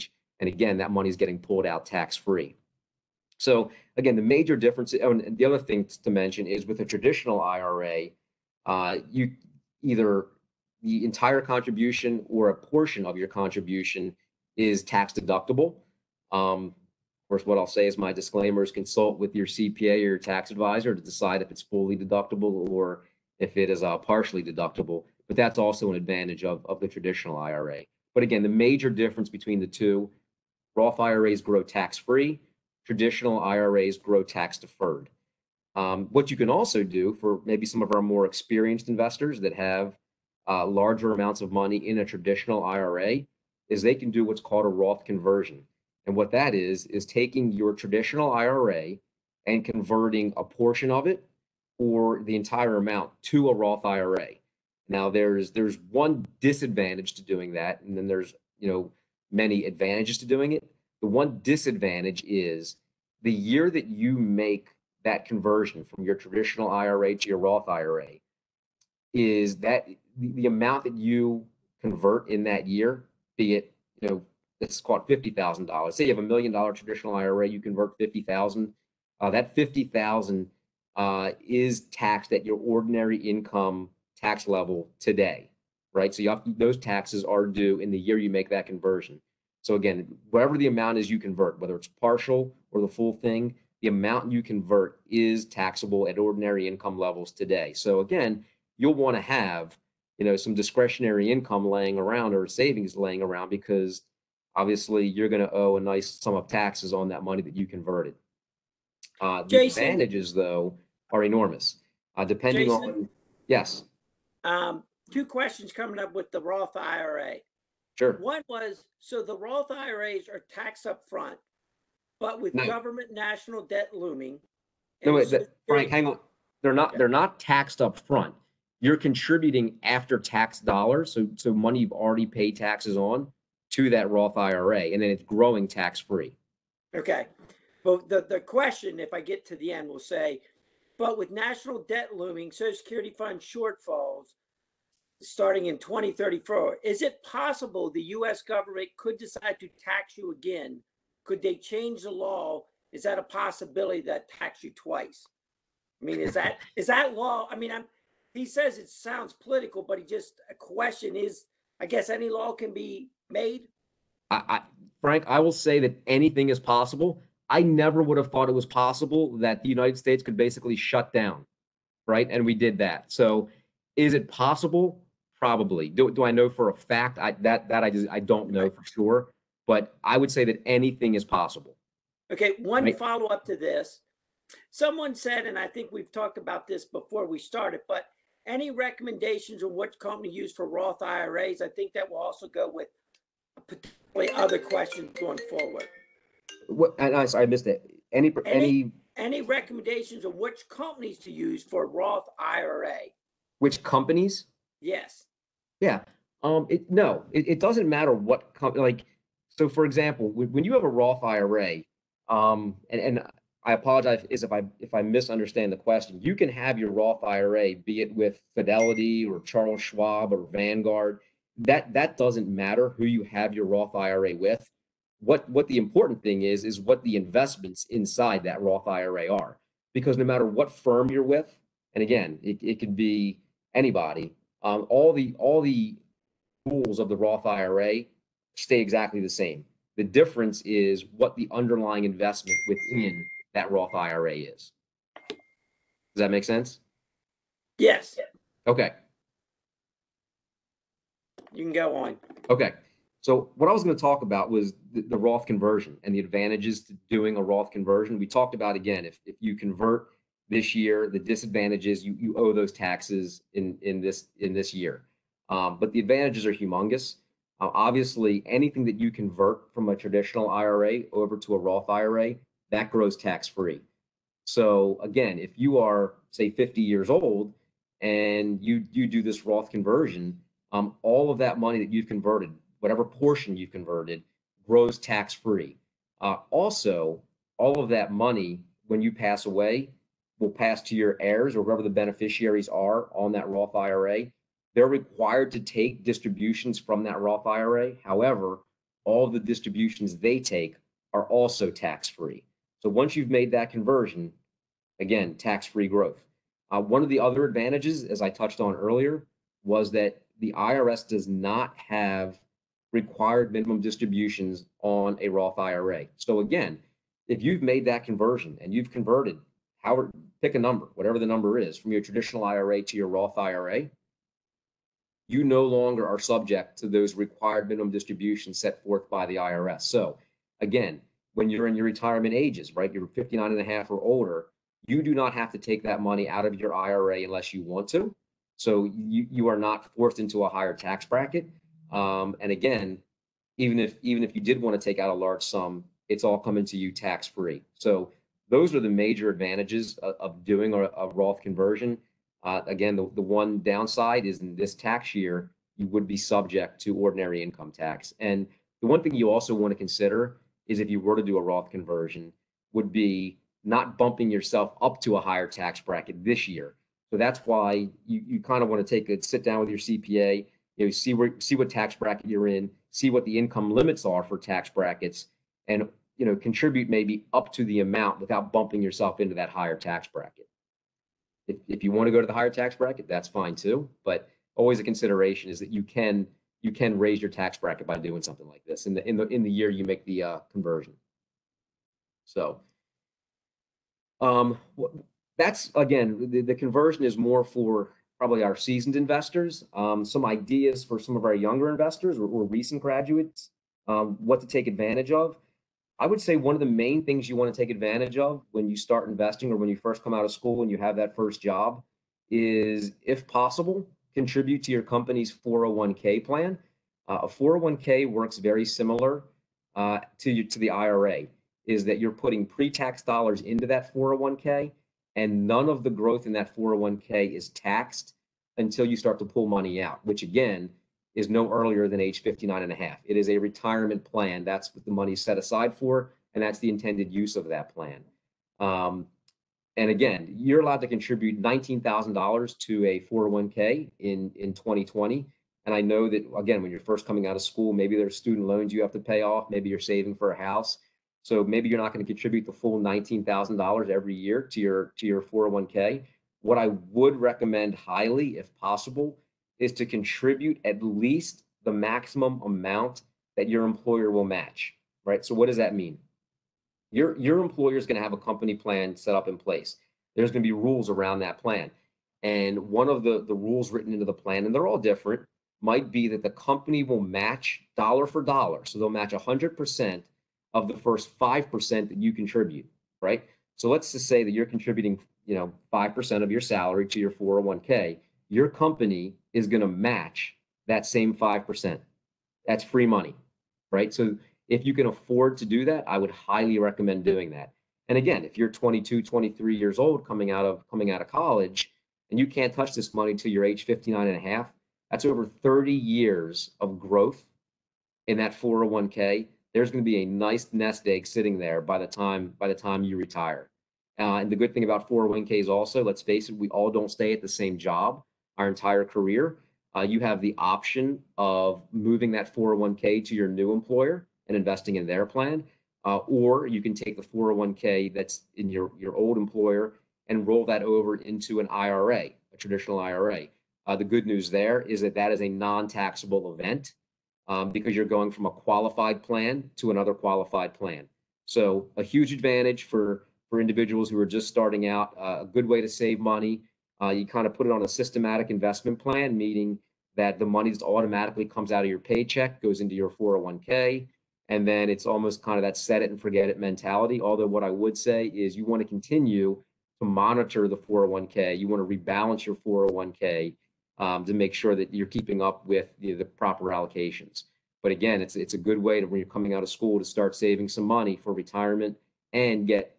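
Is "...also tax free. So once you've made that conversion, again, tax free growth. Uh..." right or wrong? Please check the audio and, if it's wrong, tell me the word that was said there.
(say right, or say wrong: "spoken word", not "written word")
right.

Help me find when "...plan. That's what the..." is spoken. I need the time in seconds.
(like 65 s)
434 s.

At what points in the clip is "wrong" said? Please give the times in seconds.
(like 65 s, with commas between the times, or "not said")
not said.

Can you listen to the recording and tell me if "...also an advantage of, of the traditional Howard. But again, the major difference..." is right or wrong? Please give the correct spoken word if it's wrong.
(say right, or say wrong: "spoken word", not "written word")
wrong: "IRA", not "Howard".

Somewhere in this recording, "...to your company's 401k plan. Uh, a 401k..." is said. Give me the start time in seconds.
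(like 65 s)
414 s.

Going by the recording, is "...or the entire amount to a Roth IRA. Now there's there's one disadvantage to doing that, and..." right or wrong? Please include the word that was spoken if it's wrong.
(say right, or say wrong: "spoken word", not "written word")
right.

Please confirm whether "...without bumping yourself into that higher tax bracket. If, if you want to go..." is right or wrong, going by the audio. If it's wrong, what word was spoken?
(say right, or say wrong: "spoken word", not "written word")
right.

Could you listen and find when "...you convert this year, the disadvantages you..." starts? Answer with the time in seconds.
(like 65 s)
259 s.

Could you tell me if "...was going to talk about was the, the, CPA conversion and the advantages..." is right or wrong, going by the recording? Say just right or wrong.
wrong.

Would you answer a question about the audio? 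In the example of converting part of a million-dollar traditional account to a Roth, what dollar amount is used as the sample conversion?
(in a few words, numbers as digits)
$50,000.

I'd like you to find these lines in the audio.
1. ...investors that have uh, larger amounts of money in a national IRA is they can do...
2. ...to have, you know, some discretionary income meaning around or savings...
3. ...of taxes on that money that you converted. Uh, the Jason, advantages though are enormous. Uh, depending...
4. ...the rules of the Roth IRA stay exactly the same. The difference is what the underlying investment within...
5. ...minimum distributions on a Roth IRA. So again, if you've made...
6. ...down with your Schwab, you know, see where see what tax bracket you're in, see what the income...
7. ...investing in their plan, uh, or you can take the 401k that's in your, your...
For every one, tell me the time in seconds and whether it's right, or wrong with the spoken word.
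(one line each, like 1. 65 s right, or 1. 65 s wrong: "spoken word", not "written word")
1. 38 s wrong: "traditional", not "national"
2. 99 s wrong: "laying", not "meaning"
3. 106 s right
4. 235 s right
5. 313 s right
6. 369 s wrong: "CPA", not "Schwab"
7. 524 s right.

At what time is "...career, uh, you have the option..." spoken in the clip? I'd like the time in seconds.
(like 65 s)
518 s.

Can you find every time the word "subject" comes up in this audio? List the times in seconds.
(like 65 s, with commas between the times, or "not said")
326 s, 356 s.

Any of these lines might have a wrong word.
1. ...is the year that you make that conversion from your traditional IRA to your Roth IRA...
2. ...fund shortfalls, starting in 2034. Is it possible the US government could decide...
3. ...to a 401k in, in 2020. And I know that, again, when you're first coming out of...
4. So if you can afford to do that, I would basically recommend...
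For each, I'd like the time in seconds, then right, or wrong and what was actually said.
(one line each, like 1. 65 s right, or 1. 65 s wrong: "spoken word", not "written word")
1. 62 s right
2. 143 s right
3. 442 s right
4. 493 s wrong: "highly", not "basically".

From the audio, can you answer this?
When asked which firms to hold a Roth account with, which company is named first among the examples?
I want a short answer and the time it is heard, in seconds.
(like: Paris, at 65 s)
Fidelity, at 218 s.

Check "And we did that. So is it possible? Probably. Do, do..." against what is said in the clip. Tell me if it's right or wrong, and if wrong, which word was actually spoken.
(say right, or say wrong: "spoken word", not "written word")
right.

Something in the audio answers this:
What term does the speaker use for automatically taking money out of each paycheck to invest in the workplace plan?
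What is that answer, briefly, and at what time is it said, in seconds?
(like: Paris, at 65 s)
systematic investment plan, at 547 s.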